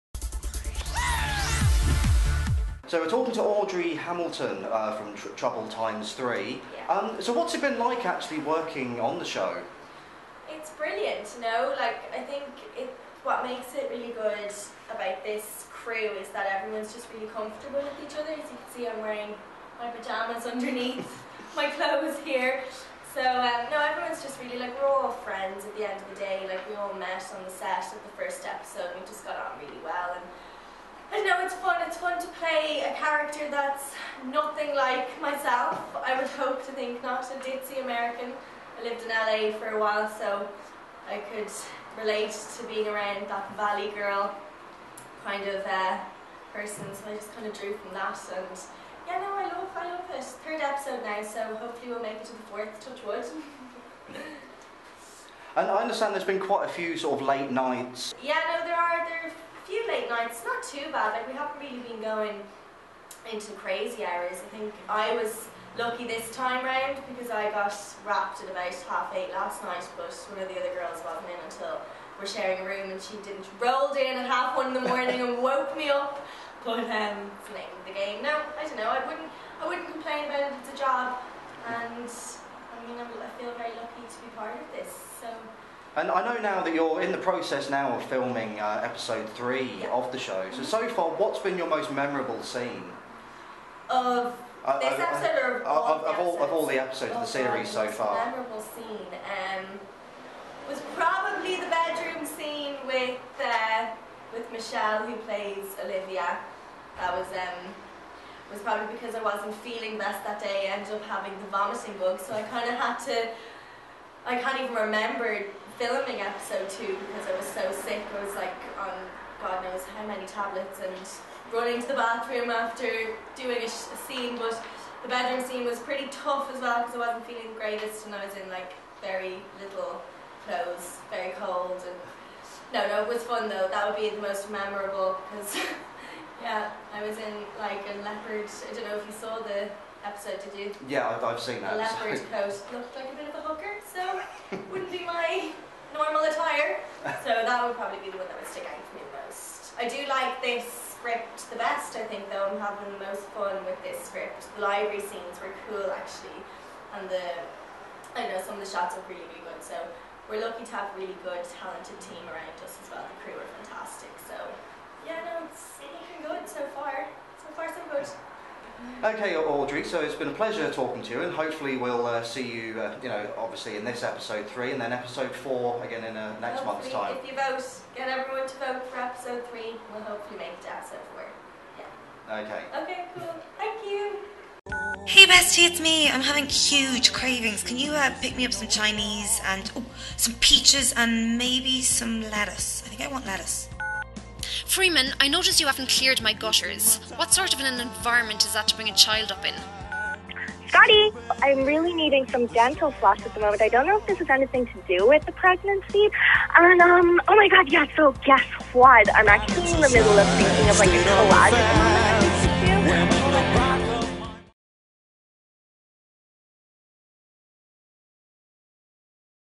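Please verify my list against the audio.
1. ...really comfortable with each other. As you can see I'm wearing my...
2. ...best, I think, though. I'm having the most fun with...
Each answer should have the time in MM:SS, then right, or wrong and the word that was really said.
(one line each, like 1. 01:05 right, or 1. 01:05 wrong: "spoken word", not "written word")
1. 00:17 right
2. 02:31 right.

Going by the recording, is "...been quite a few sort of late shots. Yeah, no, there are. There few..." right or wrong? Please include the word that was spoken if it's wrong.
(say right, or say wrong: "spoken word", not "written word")
wrong: "nights", not "shots".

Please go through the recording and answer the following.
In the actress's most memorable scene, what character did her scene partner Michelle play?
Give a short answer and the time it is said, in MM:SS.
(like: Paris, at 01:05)
Olivia, at 01:45.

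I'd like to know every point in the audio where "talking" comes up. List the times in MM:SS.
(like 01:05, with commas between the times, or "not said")
00:03, 02:50.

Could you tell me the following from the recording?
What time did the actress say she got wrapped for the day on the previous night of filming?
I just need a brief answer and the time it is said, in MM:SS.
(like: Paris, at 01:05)
half eight, at 01:08.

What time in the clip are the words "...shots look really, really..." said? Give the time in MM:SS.
02:38.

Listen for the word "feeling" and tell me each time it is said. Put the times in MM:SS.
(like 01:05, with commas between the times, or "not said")
01:49, 02:07.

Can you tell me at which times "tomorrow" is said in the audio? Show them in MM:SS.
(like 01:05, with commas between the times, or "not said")
not said.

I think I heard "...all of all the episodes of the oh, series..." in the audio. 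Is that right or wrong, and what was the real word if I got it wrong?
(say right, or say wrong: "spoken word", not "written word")
right.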